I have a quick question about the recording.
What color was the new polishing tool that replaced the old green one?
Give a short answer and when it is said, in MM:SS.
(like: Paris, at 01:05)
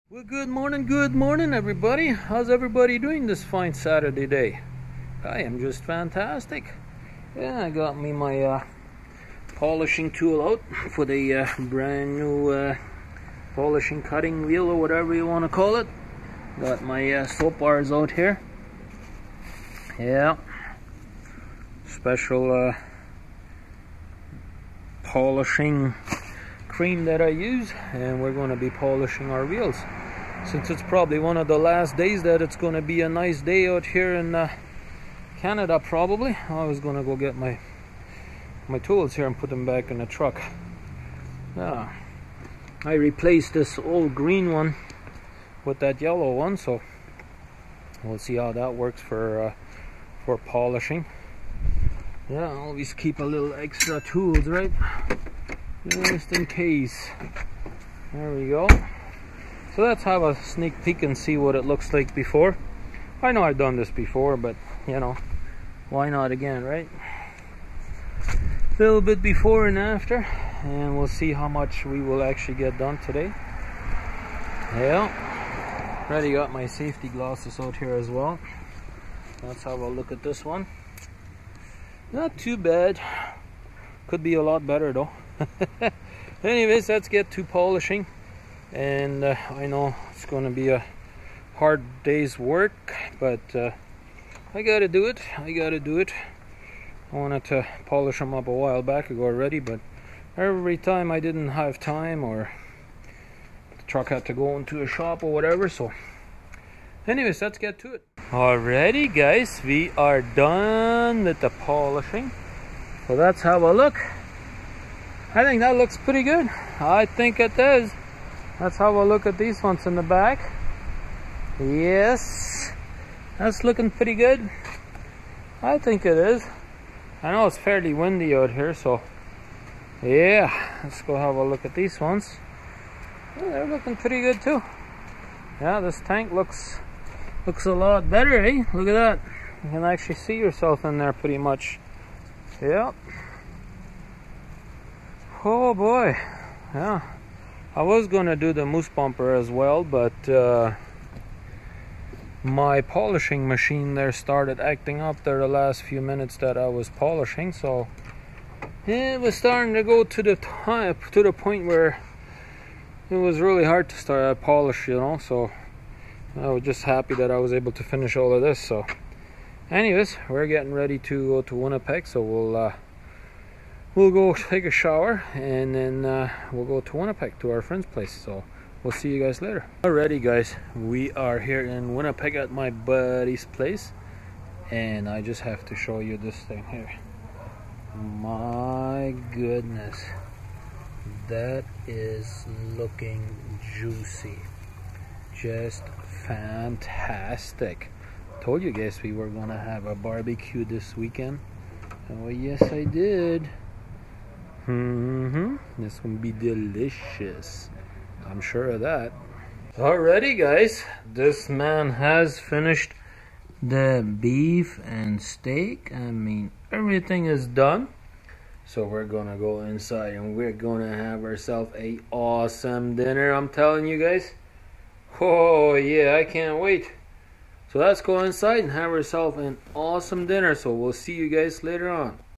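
Yellow, at 00:46.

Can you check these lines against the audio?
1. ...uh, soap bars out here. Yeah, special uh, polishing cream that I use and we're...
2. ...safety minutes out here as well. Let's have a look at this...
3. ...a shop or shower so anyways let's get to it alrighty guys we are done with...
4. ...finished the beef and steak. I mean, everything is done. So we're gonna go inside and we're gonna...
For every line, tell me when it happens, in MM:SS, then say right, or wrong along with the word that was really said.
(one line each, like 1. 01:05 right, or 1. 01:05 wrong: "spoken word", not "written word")
1. 00:17 right
2. 01:16 wrong: "glasses", not "minutes"
3. 01:44 wrong: "whatever", not "shower"
4. 03:32 right.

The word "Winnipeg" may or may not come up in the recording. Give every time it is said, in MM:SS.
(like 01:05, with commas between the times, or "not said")
02:51, 02:56, 03:01.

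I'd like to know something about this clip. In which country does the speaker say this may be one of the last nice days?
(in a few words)
Canada.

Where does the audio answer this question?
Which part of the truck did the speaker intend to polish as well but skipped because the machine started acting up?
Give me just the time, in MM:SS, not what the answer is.
02:28.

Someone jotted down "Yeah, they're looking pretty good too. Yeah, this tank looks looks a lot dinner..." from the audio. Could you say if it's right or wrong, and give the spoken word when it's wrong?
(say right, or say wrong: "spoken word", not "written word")
wrong: "better", not "dinner".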